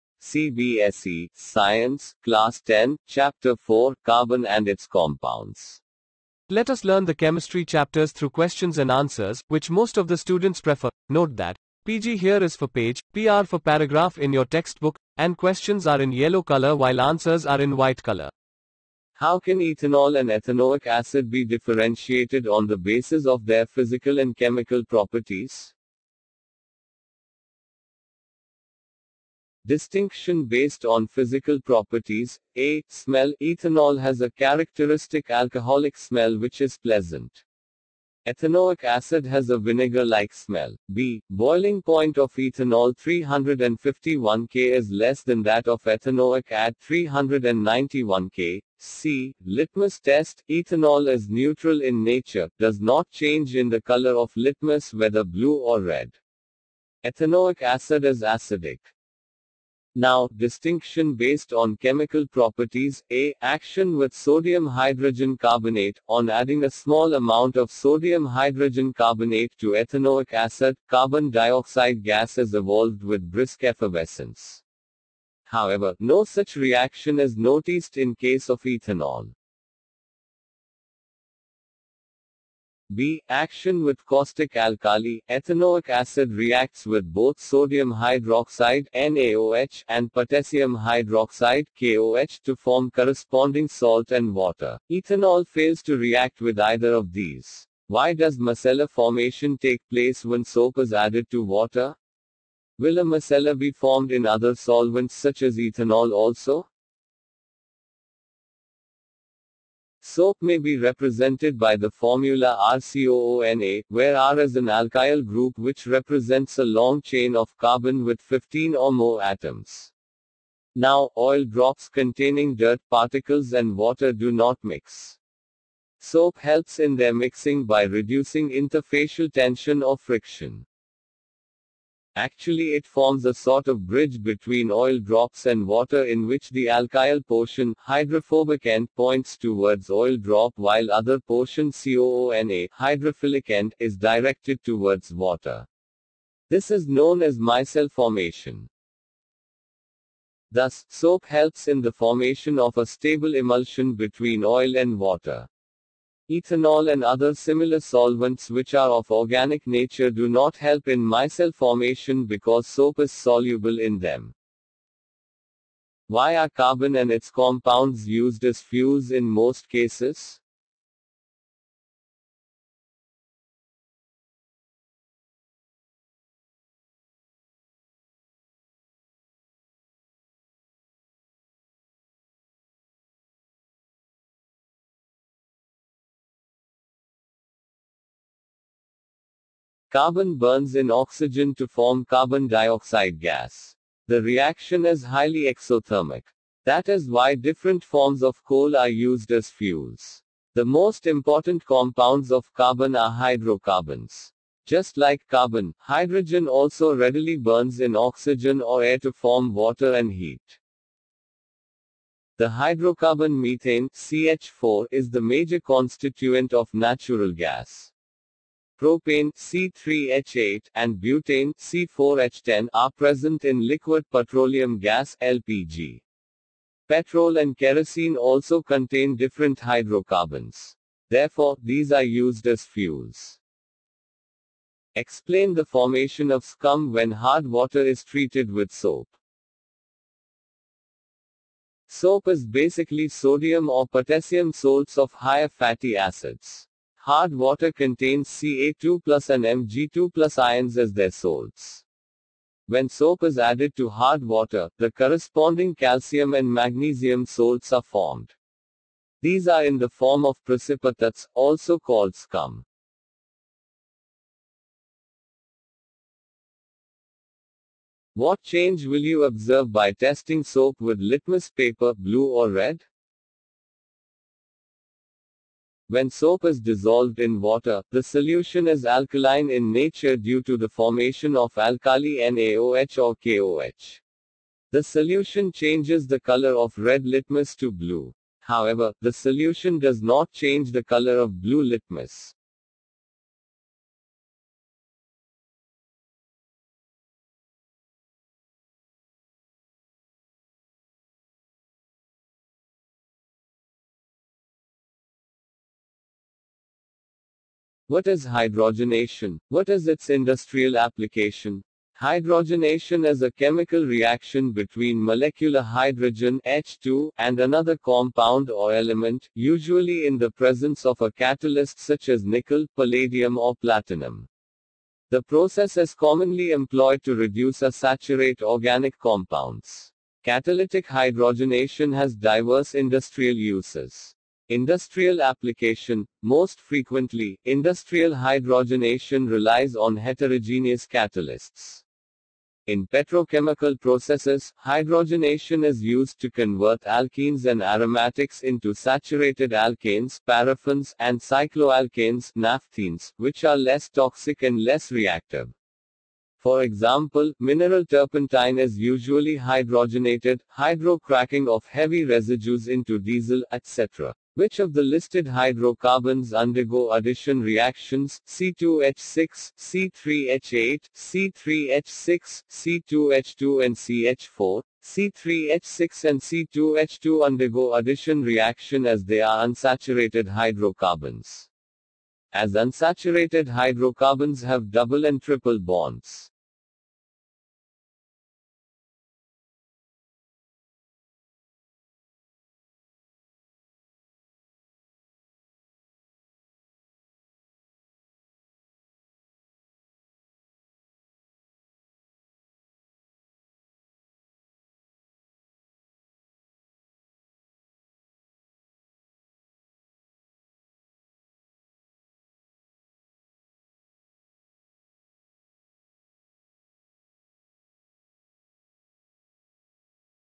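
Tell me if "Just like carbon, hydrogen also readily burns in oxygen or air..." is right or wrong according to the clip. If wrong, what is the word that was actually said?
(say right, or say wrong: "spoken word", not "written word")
right.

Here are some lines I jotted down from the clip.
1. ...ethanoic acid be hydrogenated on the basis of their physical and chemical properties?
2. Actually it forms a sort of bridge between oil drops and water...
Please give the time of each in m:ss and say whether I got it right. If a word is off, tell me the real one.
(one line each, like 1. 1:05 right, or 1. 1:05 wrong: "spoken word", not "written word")
1. 0:20 wrong: "differentiated", not "hydrogenated"
2. 2:12 right.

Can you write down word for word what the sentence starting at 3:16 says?
That is why different forms of coal are used as fuels.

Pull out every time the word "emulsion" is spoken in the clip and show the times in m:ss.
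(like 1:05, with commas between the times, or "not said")
2:33.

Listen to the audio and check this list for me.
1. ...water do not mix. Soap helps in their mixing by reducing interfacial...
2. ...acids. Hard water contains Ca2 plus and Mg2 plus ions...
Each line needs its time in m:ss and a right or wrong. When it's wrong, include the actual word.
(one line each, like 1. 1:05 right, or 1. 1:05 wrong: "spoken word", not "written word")
1. 2:03 right
2. 4:05 right.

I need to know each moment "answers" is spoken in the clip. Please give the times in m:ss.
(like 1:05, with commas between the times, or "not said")
0:08, 0:17.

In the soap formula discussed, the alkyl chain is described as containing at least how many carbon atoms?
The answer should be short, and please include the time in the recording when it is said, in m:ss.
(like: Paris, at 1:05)
15, at 1:58.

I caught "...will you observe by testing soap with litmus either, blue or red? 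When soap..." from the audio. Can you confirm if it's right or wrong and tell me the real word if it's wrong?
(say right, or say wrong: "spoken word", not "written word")
wrong: "paper", not "either".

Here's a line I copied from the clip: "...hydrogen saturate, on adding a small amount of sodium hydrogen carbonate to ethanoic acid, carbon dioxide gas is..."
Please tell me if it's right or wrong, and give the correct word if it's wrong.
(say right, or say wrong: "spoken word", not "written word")
wrong: "carbonate", not "saturate".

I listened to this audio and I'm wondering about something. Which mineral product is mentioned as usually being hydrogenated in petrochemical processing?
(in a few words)
mineral turpentine.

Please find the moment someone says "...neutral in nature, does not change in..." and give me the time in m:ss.
0:51.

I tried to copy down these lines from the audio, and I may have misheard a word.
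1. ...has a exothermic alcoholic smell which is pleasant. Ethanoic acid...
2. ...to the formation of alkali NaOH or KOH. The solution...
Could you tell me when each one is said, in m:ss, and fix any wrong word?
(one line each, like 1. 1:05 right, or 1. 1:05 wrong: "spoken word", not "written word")
1. 0:34 wrong: "characteristic", not "exothermic"
2. 4:40 right.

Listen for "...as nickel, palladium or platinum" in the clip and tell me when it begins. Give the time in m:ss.
5:22.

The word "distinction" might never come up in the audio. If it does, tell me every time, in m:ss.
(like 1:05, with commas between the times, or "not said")
0:29, 1:00.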